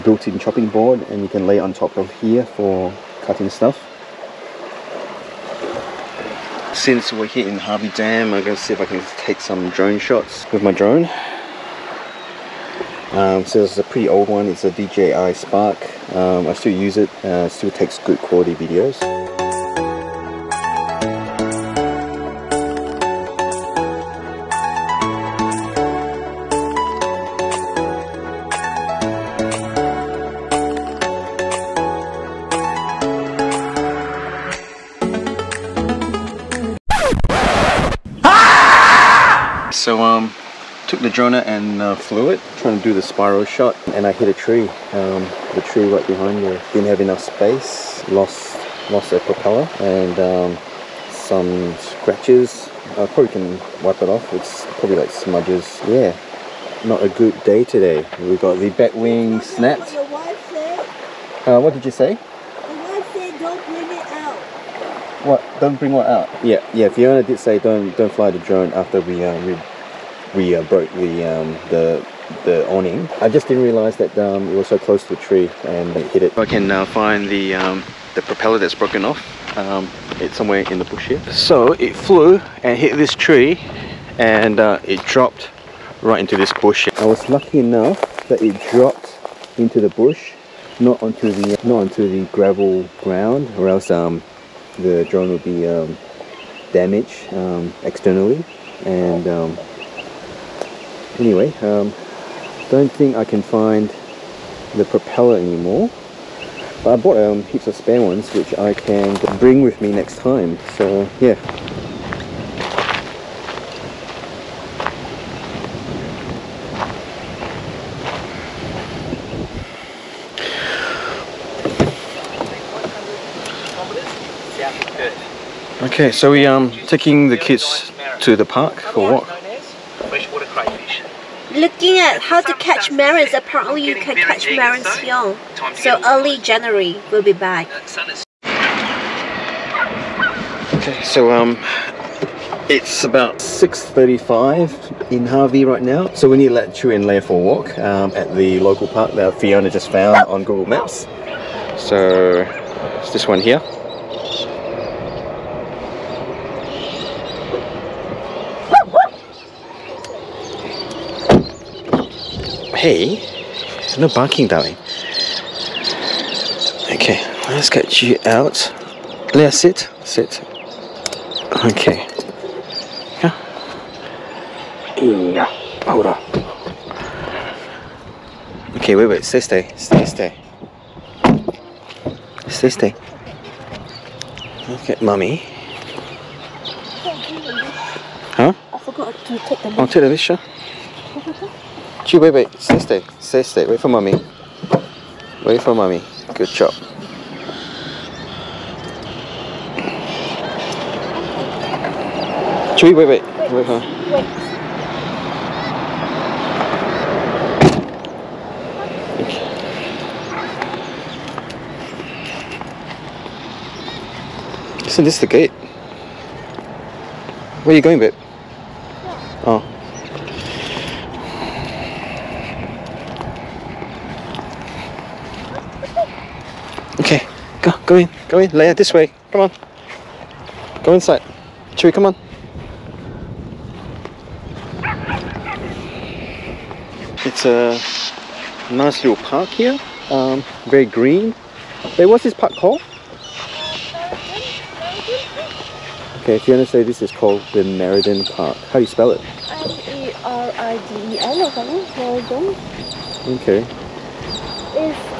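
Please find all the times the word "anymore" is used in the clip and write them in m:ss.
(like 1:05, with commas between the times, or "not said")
1:45.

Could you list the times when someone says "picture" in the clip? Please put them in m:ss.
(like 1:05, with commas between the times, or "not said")
3:10.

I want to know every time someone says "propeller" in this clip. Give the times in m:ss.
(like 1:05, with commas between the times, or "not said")
0:49, 1:18, 1:44.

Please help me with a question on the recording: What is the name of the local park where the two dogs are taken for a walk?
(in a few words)
Meriden Park.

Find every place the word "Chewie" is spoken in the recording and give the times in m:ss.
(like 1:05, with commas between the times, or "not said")
2:26, 3:22, 3:51.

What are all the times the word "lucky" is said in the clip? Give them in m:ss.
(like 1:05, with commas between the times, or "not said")
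1:27.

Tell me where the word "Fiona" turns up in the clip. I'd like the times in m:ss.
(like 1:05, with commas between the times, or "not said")
1:06, 2:29.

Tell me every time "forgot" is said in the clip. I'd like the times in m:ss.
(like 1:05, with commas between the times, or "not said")
3:08.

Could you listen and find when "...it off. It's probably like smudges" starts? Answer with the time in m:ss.
0:54.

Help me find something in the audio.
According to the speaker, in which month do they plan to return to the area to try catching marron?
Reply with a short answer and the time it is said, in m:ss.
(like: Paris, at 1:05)
January, at 2:16.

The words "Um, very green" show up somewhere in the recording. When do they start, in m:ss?
4:00.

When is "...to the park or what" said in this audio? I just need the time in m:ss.
2:08.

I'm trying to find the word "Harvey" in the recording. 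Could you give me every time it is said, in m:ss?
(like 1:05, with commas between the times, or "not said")
0:07, 2:25.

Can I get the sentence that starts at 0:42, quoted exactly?
Trying to do the spiral shot and I hit a tree.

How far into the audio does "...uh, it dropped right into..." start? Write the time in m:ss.
1:24.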